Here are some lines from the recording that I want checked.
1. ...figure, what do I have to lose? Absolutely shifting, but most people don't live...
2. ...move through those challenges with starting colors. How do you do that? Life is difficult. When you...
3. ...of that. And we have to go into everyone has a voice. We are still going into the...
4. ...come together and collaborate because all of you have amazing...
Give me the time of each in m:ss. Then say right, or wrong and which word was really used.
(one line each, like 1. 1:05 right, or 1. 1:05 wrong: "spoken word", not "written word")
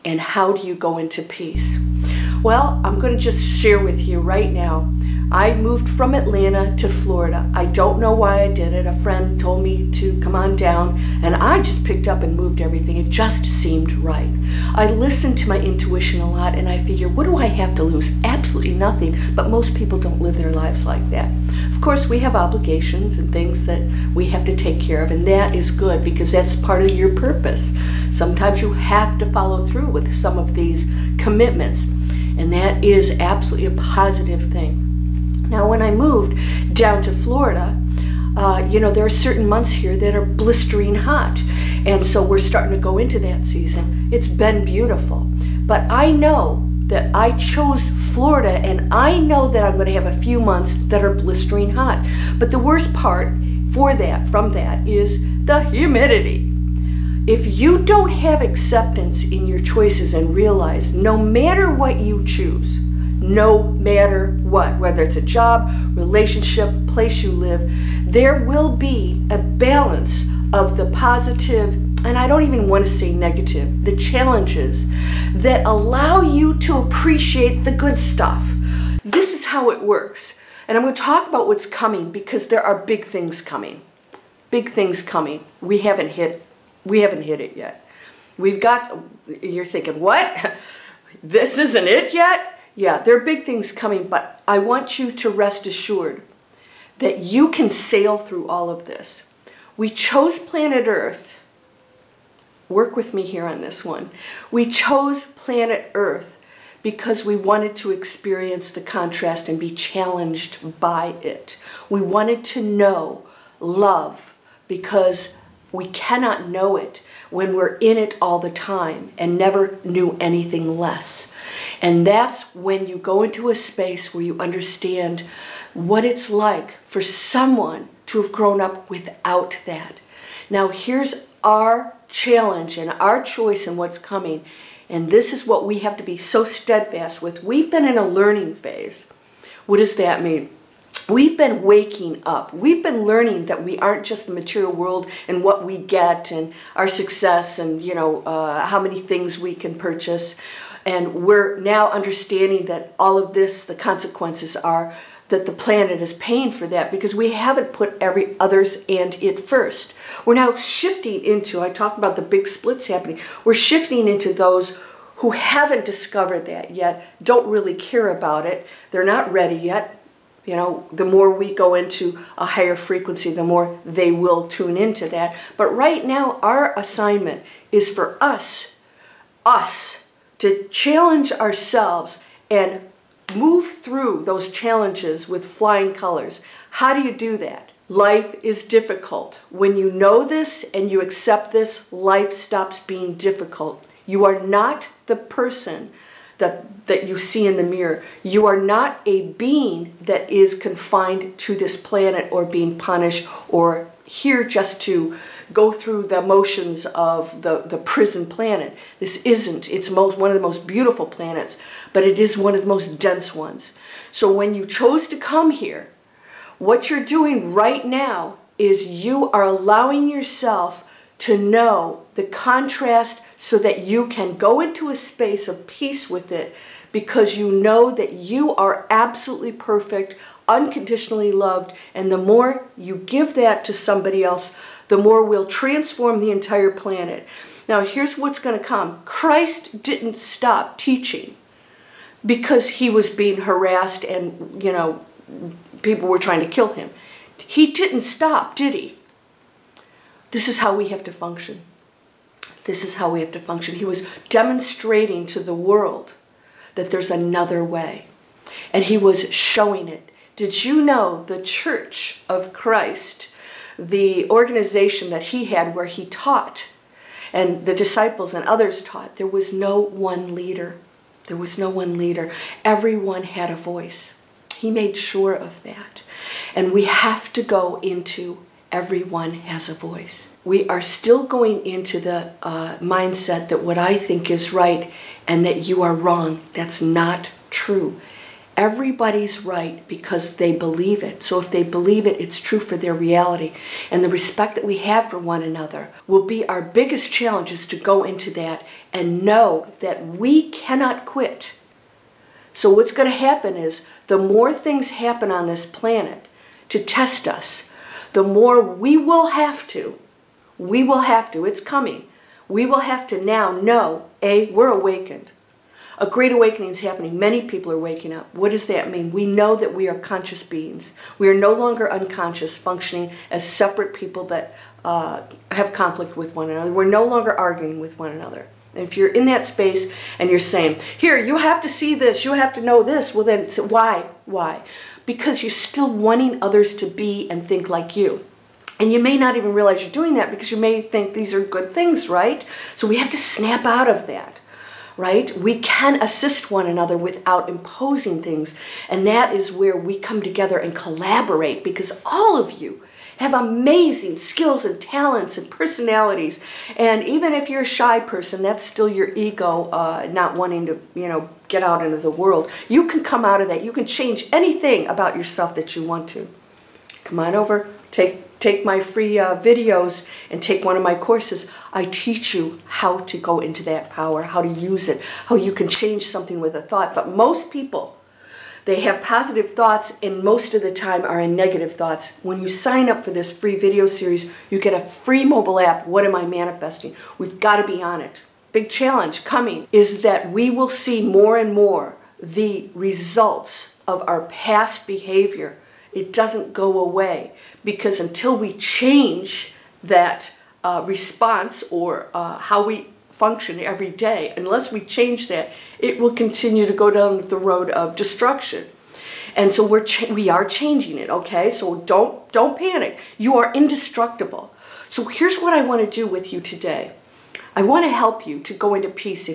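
1. 0:16 wrong: "nothing", not "shifting"
2. 3:03 wrong: "flying", not "starting"
3. 4:35 right
4. 5:49 right.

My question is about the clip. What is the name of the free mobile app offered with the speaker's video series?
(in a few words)
What Am I Manifesting?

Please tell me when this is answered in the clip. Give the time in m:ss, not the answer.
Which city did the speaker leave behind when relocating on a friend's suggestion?
0:06.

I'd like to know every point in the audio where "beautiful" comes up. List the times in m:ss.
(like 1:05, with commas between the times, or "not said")
0:44, 3:30.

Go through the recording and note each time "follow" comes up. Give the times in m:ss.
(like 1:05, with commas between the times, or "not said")
0:29.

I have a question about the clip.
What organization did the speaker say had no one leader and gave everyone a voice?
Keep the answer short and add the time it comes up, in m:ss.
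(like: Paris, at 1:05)
The Church of Christ, at 4:21.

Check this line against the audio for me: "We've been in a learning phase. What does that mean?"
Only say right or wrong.
right.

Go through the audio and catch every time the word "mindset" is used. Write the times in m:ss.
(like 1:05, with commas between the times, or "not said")
4:42.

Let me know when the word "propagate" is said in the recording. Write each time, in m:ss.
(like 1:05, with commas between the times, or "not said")
not said.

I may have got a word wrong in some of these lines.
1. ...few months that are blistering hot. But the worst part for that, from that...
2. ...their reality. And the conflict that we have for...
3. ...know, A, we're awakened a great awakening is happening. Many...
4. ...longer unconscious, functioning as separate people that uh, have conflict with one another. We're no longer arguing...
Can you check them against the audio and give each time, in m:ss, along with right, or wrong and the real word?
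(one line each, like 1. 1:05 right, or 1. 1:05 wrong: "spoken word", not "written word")
1. 0:50 right
2. 4:52 wrong: "respect", not "conflict"
3. 5:13 right
4. 5:21 right.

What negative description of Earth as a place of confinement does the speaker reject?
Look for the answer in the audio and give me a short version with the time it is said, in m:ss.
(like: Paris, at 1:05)
Prison planet, at 3:27.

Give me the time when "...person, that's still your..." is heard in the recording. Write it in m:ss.
5:58.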